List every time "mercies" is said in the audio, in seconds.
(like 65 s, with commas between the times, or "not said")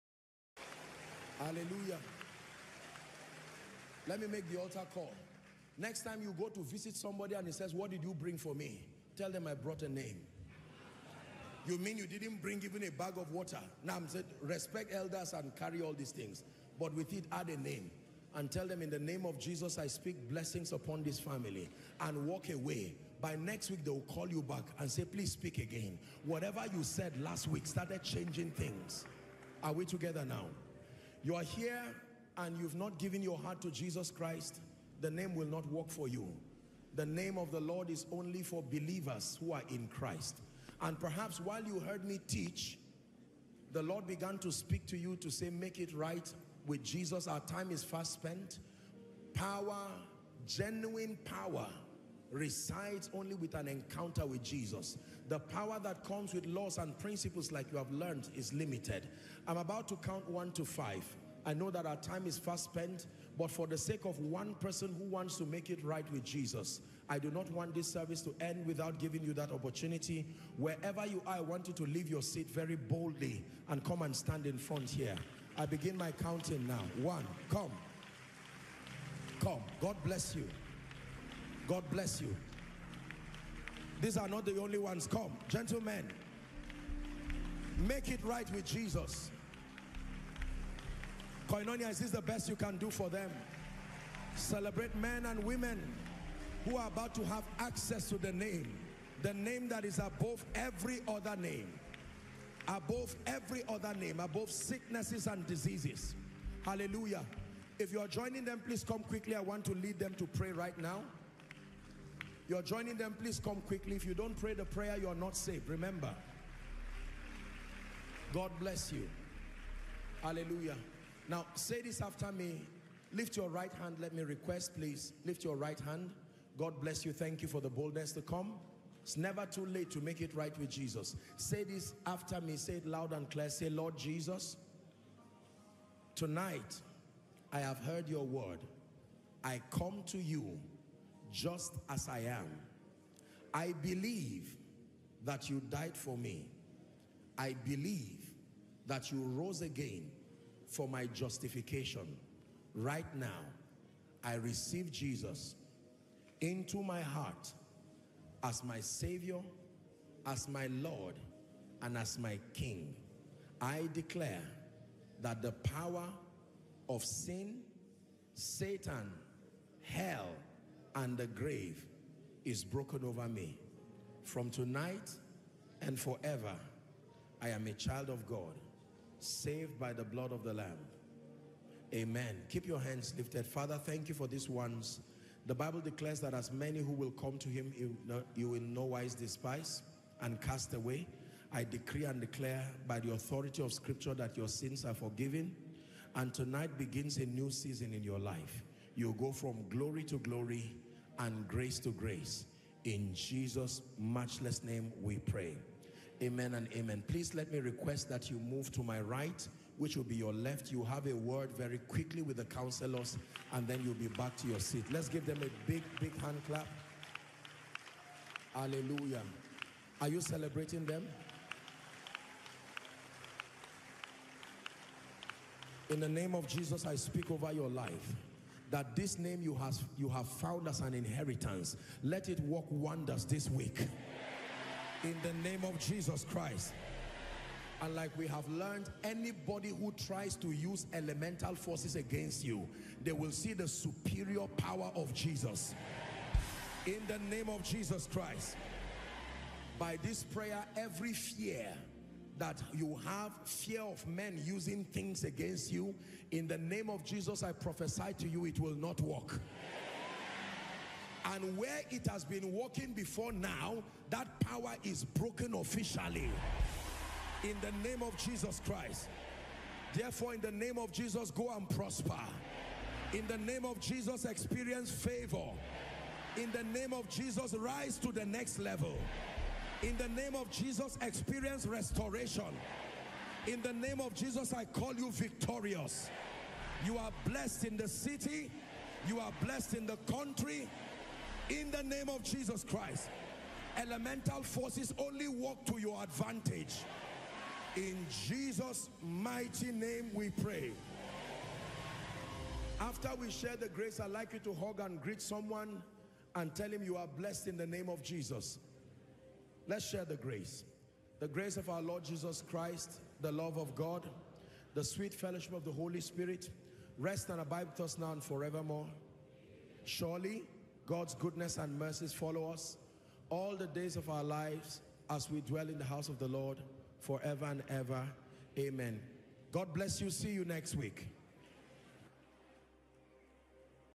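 321 s.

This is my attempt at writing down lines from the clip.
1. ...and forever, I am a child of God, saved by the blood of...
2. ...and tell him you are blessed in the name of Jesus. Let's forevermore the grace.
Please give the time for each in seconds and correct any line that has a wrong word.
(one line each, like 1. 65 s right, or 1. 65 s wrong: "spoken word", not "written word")
1. 175 s right
2. 306 s wrong: "share", not "forevermore".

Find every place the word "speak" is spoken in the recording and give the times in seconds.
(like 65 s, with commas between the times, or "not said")
19 s, 25 s, 44 s, 226 s.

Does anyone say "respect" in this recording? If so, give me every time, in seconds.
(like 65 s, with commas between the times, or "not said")
14 s.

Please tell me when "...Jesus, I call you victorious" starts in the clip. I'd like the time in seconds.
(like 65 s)
284 s.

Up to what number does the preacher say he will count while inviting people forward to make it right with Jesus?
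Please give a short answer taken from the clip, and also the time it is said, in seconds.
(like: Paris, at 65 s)
5, at 60 s.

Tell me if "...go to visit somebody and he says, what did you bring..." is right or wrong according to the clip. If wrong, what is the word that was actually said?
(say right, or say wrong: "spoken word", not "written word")
right.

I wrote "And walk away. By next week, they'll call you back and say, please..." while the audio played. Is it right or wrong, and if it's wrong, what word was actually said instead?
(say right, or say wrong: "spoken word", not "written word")
right.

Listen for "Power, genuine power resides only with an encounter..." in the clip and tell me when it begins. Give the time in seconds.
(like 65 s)
49 s.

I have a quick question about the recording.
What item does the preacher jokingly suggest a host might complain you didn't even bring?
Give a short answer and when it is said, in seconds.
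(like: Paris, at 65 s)
A bag of water, at 12 s.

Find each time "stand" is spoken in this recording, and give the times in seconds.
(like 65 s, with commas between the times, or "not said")
74 s.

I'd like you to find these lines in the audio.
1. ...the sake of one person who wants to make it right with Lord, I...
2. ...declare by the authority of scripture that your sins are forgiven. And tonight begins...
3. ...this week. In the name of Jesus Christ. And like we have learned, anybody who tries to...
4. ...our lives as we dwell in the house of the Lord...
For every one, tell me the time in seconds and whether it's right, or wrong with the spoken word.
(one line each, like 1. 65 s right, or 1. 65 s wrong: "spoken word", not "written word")
1. 63 s wrong: "Jesus", not "Lord"
2. 192 s right
3. 233 s right
4. 324 s right.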